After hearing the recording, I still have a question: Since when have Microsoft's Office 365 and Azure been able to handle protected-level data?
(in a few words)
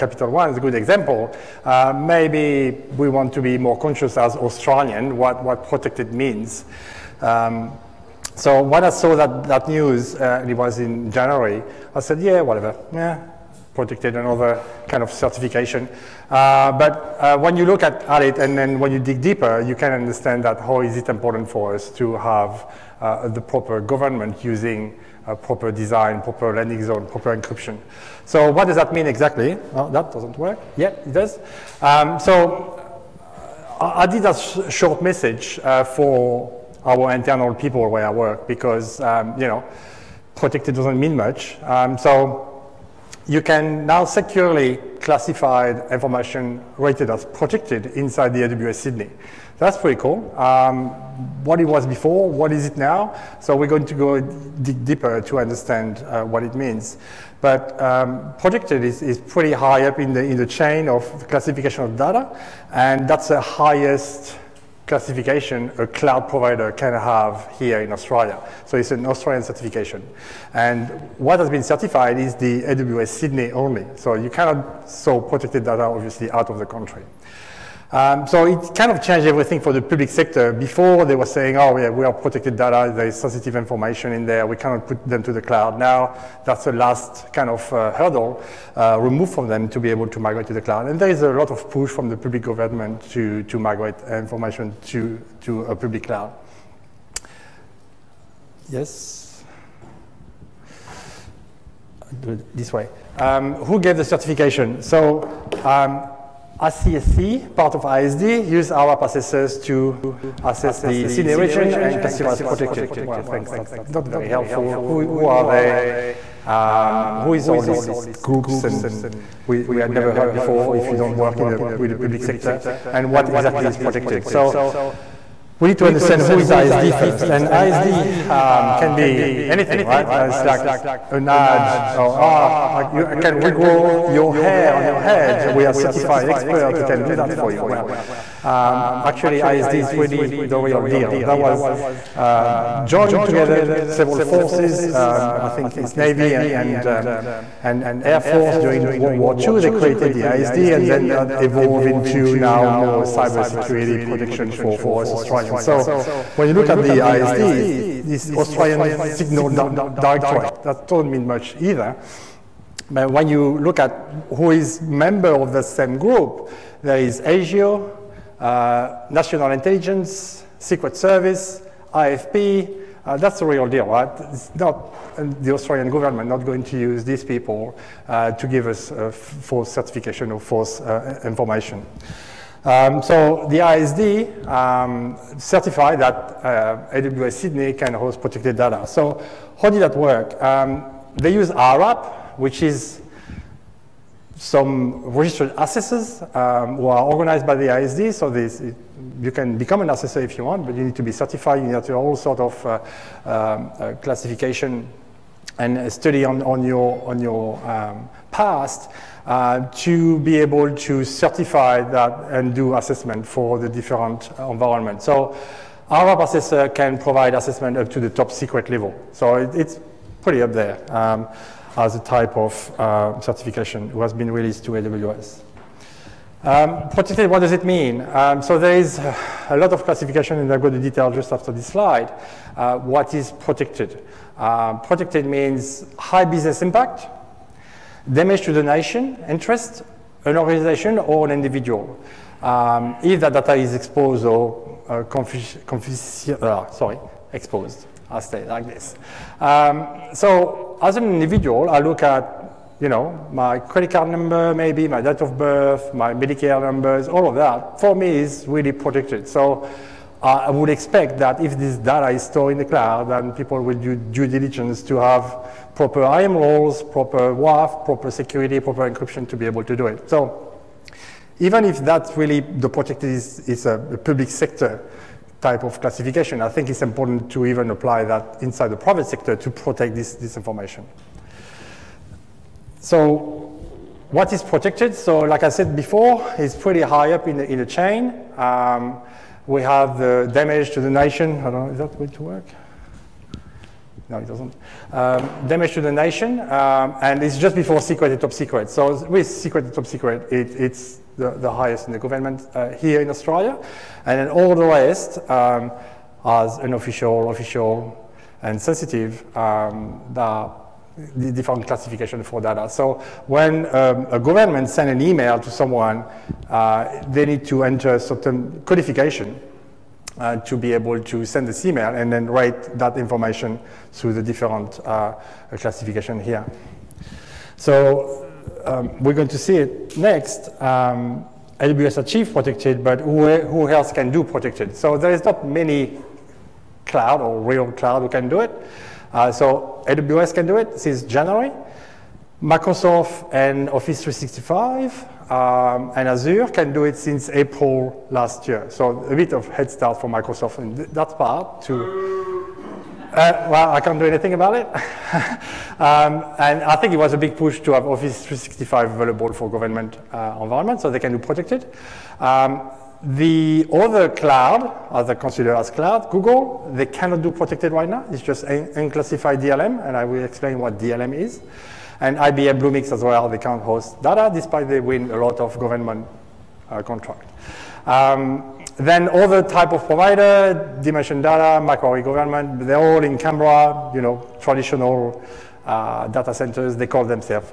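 April last year.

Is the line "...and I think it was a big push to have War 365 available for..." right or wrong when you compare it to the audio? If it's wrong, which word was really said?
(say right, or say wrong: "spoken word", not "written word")
wrong: "Office", not "War".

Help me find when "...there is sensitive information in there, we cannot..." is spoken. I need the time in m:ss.
1:22.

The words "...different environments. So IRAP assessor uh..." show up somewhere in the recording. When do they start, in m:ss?
3:33.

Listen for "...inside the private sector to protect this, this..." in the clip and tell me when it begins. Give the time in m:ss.
4:38.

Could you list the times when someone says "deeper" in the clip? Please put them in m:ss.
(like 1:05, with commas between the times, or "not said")
0:19, 0:54.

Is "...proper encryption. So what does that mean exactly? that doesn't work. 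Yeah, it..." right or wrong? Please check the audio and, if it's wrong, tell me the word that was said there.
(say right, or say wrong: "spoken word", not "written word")
right.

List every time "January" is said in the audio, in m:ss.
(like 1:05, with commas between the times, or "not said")
0:11, 5:41.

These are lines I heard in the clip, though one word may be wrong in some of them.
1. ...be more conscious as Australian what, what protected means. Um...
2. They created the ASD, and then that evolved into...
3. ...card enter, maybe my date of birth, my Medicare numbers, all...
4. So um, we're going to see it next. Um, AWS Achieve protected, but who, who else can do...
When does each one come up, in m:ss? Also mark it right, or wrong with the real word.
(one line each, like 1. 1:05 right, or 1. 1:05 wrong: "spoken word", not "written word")
1. 0:03 right
2. 2:29 right
3. 4:13 wrong: "number", not "enter"
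4. 5:27 right.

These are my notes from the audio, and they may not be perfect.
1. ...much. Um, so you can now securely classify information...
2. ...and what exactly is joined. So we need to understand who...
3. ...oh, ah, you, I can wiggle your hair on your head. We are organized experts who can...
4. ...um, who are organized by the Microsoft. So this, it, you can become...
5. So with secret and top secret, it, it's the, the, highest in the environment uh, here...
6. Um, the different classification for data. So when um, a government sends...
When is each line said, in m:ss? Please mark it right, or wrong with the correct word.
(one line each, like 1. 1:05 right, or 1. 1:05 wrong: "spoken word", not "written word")
1. 0:41 right
2. 2:02 wrong: "protected", not "joined"
3. 2:11 wrong: "certified", not "organized"
4. 3:16 wrong: "ASD", not "Microsoft"
5. 4:58 wrong: "government", not "environment"
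6. 5:09 right.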